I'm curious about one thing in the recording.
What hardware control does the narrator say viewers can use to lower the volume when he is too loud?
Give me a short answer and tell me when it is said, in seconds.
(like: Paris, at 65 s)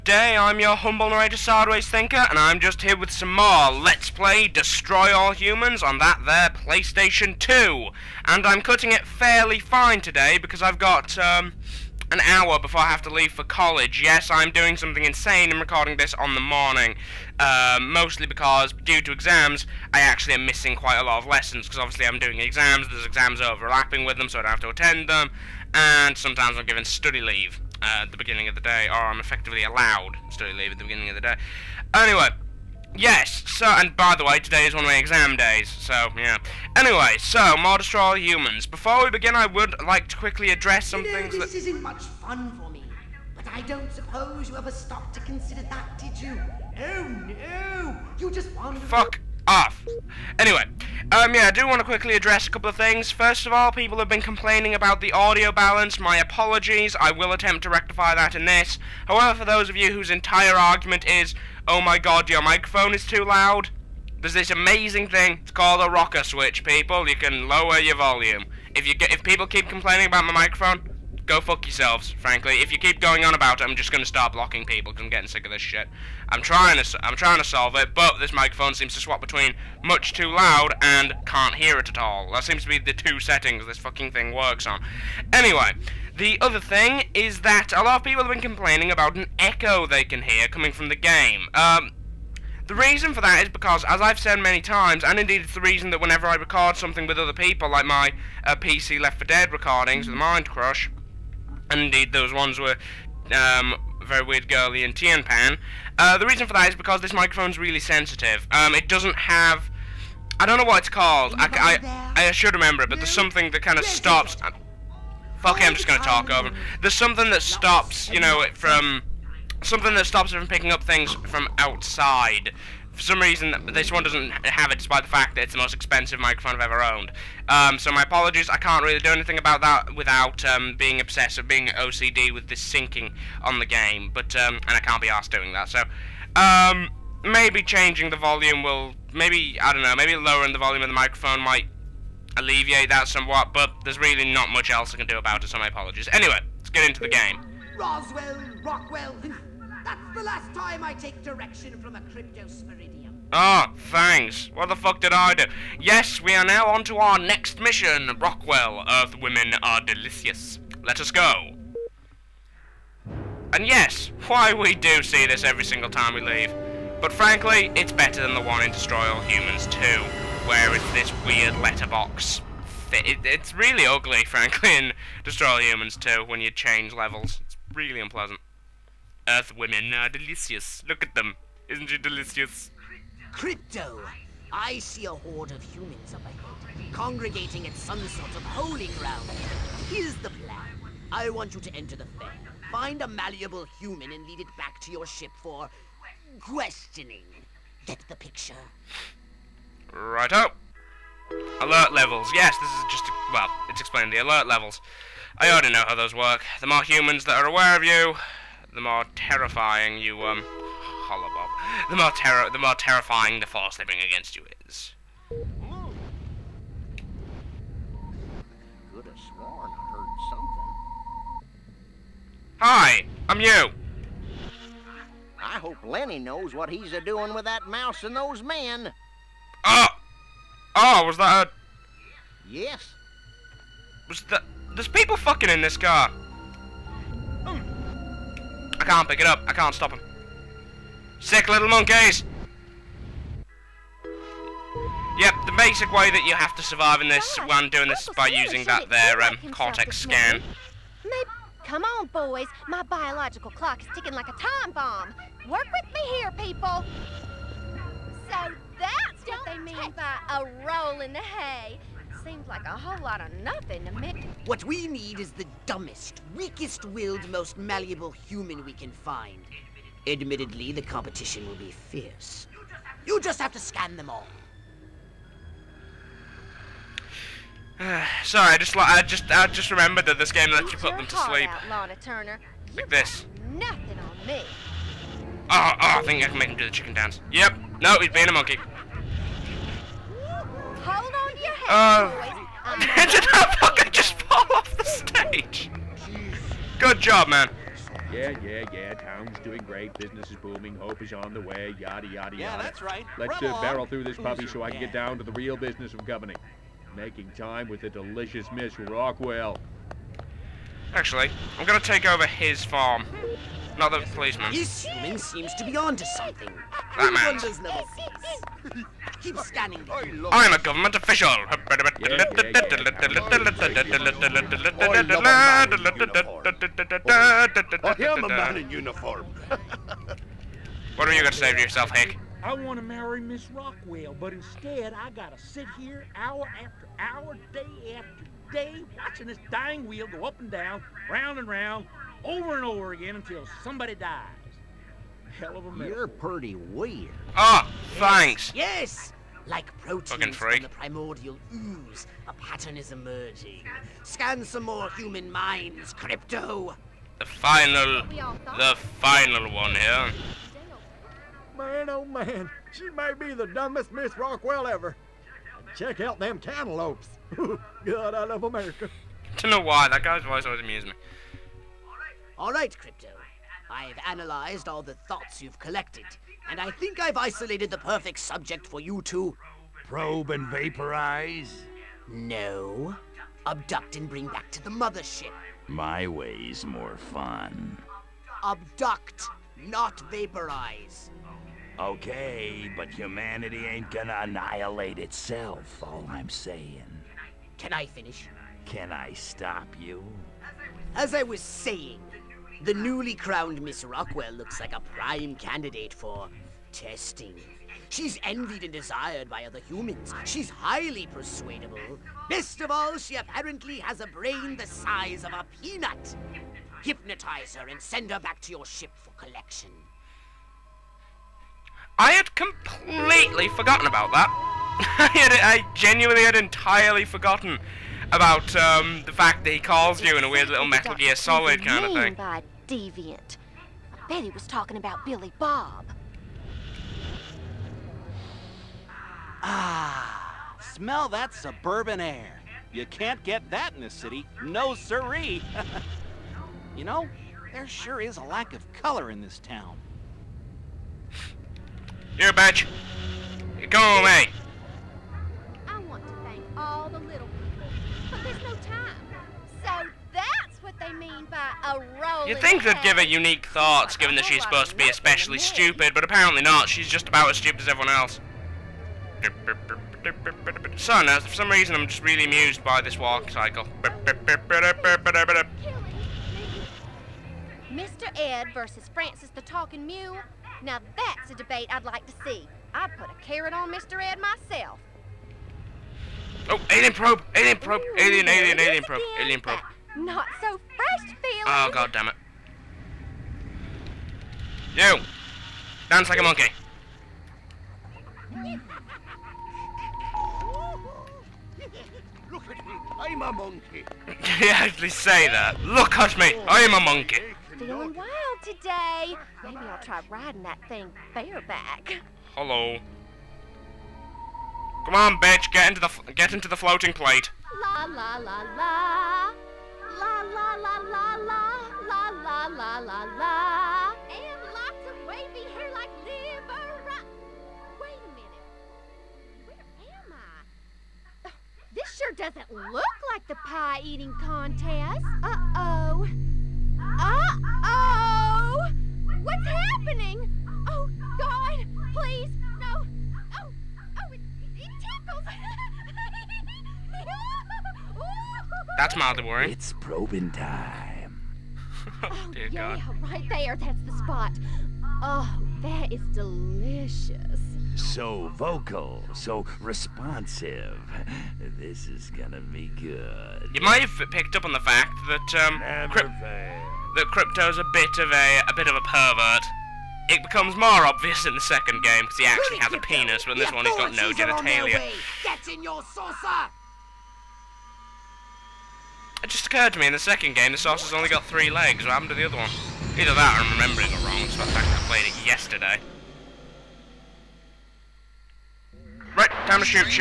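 rocker switch, at 65 s.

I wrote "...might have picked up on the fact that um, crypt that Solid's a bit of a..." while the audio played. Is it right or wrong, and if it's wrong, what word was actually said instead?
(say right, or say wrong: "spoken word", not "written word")
wrong: "Crypto", not "Solid".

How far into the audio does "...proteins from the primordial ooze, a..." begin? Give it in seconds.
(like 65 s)
349 s.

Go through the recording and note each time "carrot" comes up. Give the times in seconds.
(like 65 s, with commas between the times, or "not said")
483 s.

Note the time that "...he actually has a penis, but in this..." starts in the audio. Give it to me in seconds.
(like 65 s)
572 s.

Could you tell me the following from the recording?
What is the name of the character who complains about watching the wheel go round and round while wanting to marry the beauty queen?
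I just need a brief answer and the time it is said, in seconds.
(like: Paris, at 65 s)
Hank, at 331 s.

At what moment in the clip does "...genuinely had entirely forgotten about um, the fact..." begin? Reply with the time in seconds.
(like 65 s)
425 s.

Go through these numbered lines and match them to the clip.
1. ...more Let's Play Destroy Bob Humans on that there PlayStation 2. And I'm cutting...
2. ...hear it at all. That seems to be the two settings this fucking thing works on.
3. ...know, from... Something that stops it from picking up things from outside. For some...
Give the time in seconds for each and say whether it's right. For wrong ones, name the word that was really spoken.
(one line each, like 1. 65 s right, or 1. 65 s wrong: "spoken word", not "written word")
1. 3 s wrong: "All", not "Bob"
2. 81 s right
3. 118 s right.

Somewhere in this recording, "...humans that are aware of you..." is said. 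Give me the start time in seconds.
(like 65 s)
206 s.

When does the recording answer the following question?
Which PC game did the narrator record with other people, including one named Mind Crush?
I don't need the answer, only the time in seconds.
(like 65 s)
98 s.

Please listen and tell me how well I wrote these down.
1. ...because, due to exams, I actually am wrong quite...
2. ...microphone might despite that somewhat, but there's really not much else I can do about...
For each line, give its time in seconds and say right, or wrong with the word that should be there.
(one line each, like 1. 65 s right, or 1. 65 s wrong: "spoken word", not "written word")
1. 18 s wrong: "missing", not "wrong"
2. 140 s wrong: "alleviate", not "despite".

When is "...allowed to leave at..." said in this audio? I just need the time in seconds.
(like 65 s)
29 s.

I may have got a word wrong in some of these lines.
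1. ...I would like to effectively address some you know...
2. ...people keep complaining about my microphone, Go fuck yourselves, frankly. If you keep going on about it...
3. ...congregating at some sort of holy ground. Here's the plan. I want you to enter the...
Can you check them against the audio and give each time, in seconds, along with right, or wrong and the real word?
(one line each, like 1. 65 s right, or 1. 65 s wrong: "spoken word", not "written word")
1. 39 s wrong: "quickly", not "effectively"
2. 69 s right
3. 186 s right.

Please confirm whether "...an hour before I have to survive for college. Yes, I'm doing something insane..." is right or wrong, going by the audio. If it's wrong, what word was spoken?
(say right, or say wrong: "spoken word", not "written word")
wrong: "leave", not "survive".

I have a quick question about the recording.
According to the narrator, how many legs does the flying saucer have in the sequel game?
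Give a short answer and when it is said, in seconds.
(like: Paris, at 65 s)
3, at 581 s.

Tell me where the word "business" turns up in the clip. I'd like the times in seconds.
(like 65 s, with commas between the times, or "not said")
299 s, 305 s.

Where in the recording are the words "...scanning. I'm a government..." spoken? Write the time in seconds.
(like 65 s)
319 s.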